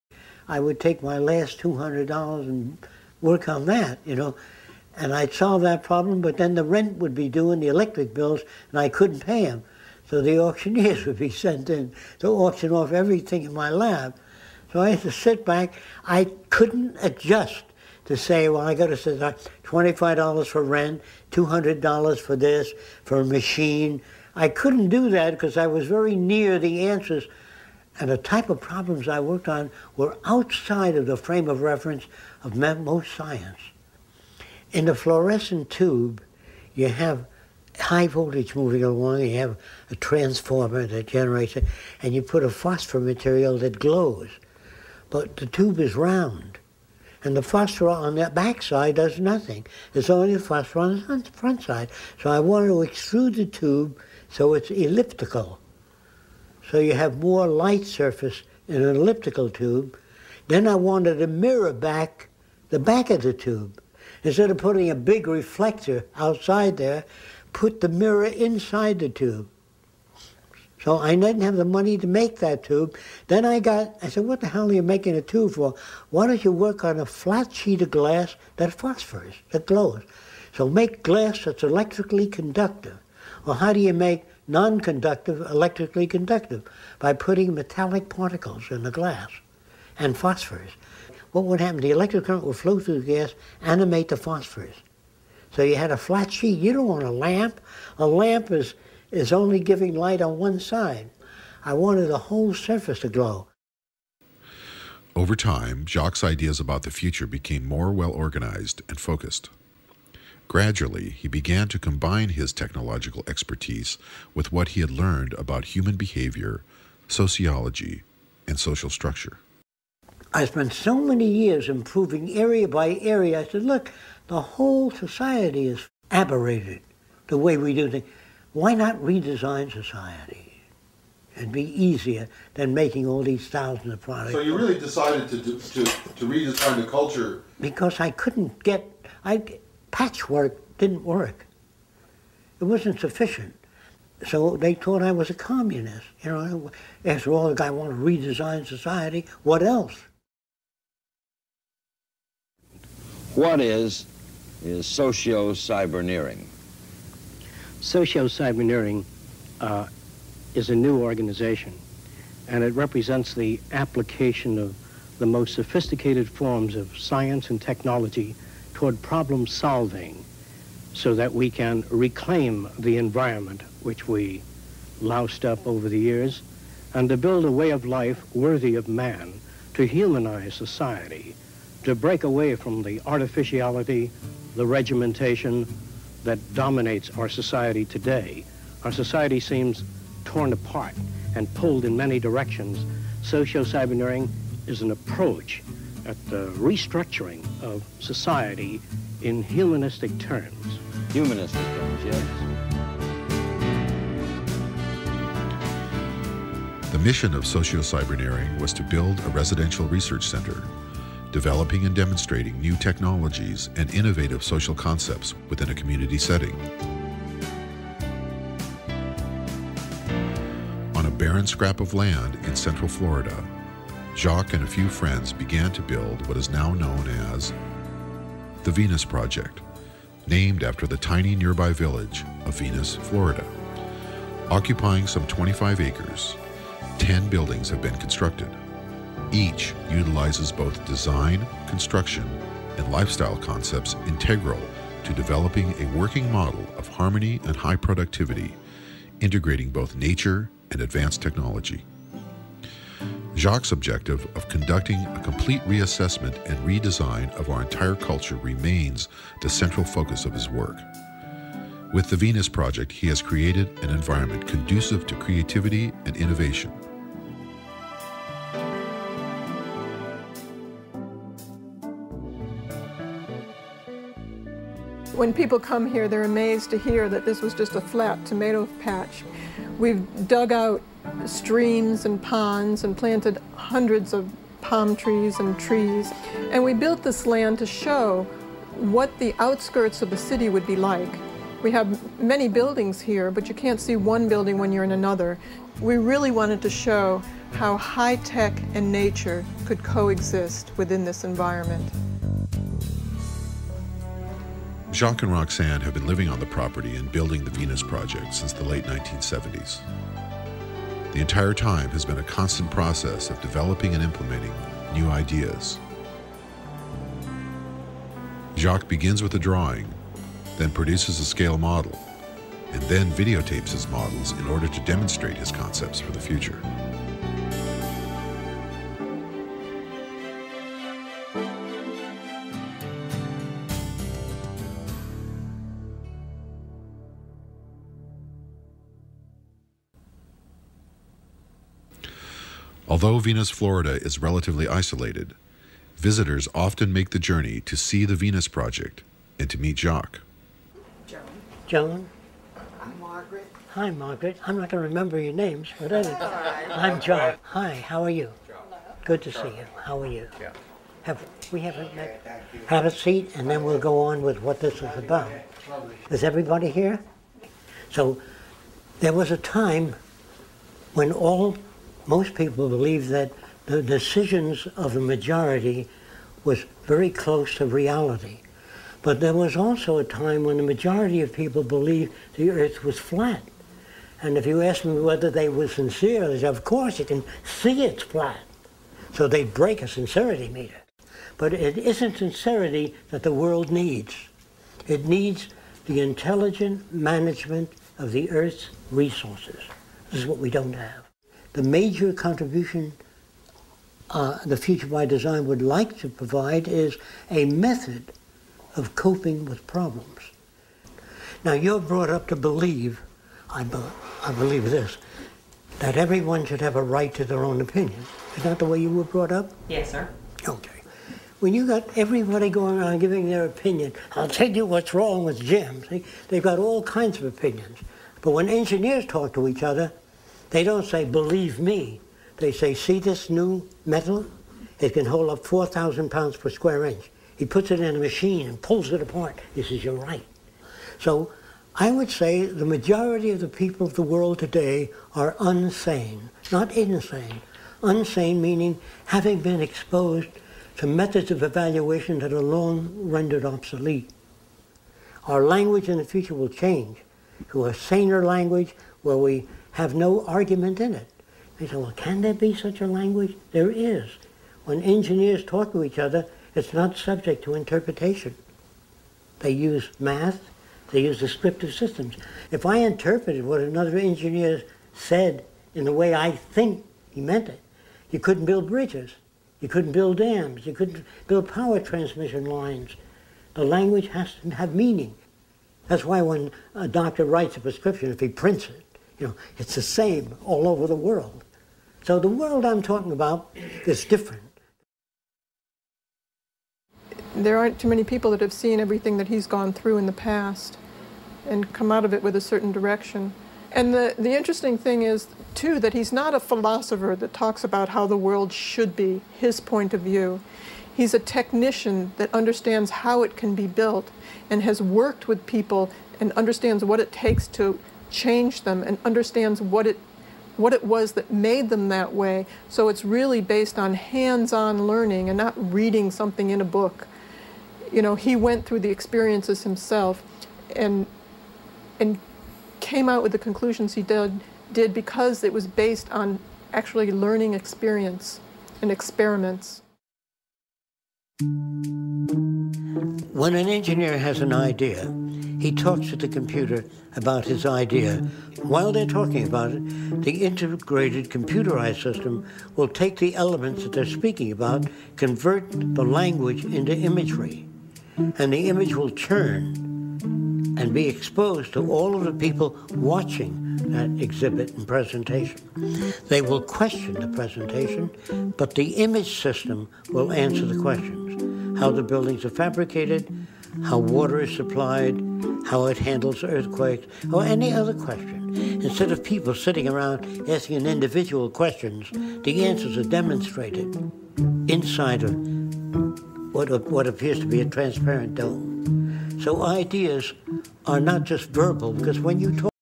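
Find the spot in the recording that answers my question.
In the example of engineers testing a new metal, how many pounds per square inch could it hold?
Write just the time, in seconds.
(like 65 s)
435 s.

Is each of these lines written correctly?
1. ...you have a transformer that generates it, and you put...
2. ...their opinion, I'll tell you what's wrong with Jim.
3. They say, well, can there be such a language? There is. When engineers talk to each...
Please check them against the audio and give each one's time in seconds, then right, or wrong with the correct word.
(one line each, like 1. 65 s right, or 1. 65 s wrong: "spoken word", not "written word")
1. 39 s right
2. 423 s right
3. 461 s right.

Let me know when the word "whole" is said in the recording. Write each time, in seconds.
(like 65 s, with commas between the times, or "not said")
102 s, 124 s.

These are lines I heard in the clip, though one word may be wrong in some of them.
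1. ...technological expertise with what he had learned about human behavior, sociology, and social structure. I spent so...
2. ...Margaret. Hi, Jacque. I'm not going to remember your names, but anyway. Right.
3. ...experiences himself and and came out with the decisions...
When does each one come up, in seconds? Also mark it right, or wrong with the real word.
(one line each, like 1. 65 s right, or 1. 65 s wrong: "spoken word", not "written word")
1. 112 s right
2. 352 s wrong: "Margaret", not "Jacque"
3. 528 s wrong: "conclusions", not "decisions".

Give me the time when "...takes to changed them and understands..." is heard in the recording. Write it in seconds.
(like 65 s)
517 s.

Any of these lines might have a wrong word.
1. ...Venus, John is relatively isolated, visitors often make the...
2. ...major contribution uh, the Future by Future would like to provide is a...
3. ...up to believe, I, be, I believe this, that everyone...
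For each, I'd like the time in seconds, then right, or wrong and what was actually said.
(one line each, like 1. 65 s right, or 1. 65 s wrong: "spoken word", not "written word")
1. 343 s wrong: "Florida", not "John"
2. 401 s wrong: "Design", not "Future"
3. 412 s right.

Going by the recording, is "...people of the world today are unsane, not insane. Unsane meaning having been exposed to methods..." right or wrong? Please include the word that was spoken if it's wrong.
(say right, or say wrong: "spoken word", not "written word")
right.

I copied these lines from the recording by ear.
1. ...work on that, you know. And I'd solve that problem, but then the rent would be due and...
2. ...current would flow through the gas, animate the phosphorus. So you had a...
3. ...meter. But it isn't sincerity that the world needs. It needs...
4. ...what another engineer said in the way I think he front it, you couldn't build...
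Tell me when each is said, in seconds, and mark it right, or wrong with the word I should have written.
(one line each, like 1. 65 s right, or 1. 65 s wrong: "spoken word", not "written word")
1. 3 s right
2. 92 s right
3. 390 s right
4. 473 s wrong: "meant", not "front".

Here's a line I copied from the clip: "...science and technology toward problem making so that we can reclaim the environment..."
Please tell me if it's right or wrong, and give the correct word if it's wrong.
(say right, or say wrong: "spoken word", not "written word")
wrong: "solving", not "making".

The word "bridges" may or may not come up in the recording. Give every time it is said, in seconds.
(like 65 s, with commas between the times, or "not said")
478 s.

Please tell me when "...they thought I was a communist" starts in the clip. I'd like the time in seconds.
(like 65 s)
144 s.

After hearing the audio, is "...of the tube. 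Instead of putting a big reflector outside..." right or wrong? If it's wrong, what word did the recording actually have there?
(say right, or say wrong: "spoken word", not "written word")
right.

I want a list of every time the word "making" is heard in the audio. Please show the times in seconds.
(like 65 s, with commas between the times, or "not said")
74 s, 132 s.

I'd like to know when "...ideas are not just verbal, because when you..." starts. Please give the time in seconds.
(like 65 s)
589 s.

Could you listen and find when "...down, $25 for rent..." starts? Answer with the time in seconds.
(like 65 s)
19 s.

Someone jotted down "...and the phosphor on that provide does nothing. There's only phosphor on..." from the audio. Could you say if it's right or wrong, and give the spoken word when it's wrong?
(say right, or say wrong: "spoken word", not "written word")
wrong: "backside", not "provide".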